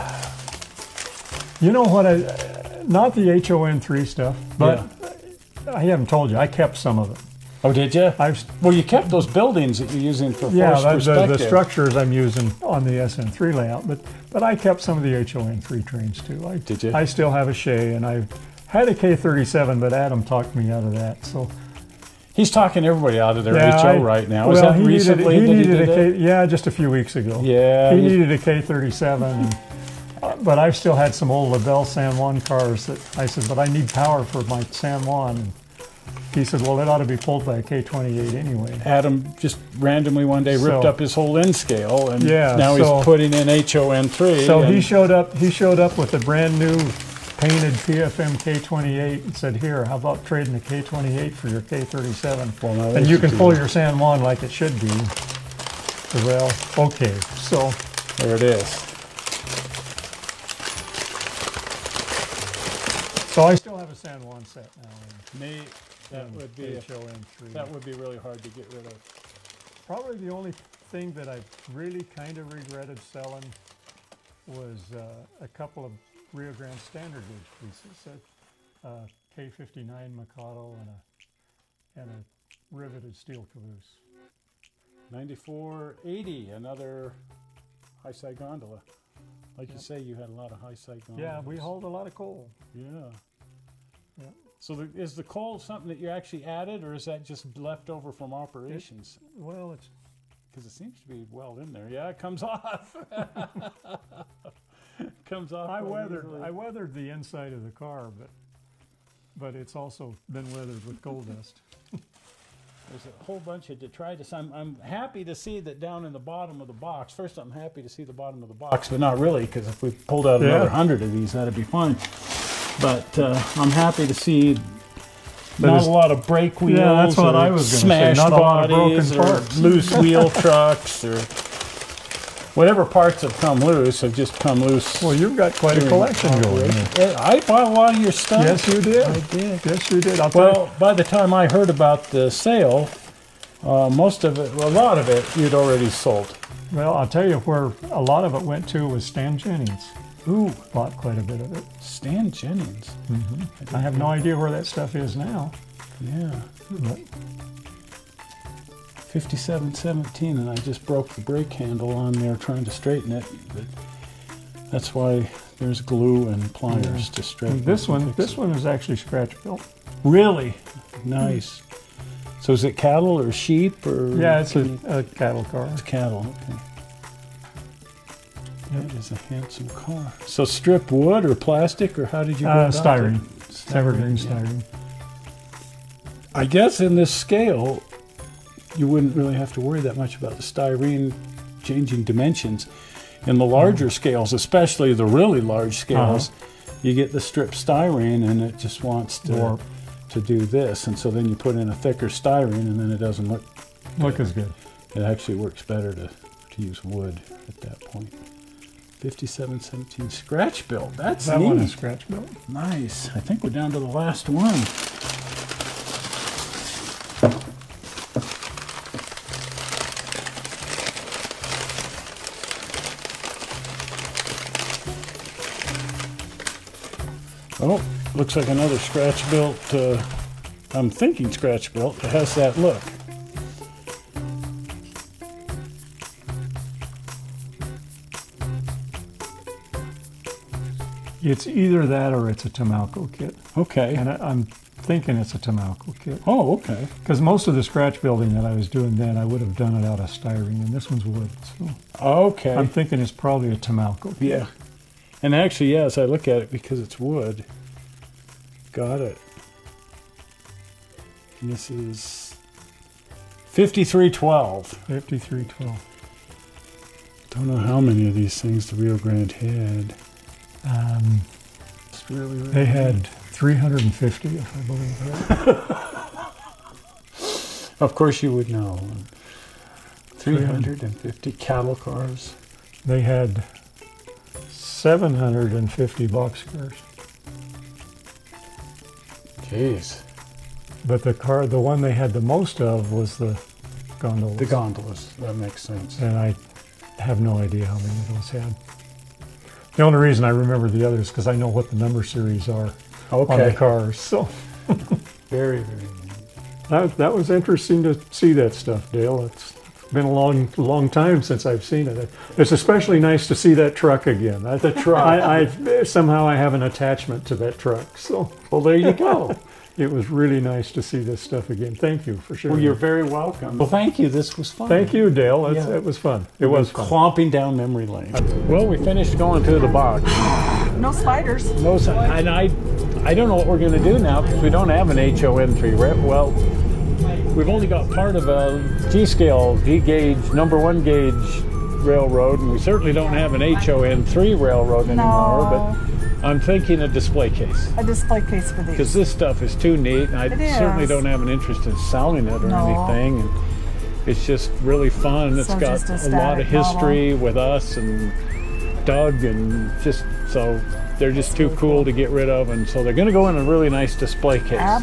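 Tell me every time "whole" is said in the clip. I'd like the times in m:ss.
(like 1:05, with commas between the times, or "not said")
0:41, 1:53.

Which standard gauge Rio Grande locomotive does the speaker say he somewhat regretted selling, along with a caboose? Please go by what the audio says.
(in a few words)
K59 Mikado.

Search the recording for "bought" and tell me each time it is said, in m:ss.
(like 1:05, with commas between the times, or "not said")
2:17, 2:30.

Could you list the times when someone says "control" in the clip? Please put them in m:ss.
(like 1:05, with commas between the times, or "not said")
not said.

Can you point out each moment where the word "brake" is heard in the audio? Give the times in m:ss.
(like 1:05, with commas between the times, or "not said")
2:06, 2:41.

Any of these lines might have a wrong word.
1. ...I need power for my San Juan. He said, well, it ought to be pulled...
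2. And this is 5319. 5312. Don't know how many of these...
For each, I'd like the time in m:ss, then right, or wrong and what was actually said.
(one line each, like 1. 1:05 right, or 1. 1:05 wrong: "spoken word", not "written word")
1. 0:33 right
2. 4:21 wrong: "5312", not "5319".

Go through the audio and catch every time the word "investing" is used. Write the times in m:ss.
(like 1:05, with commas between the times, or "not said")
not said.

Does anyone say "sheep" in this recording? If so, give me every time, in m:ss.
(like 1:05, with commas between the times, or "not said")
2:53.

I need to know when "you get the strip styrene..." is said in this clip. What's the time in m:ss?
3:16.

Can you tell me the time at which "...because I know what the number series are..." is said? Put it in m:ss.
5:01.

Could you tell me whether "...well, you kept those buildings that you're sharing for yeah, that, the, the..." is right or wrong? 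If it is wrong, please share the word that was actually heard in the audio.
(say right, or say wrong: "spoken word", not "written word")
wrong: "using", not "sharing".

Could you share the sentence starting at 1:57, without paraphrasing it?
First, I'm happy to see the bottom of the box, but not really, because if we pulled out yeah.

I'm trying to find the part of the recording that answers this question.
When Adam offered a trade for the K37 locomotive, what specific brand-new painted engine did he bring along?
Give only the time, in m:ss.
0:47.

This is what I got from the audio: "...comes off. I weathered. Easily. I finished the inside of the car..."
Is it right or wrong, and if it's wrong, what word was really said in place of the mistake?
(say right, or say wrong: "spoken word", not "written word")
wrong: "weathered", not "finished".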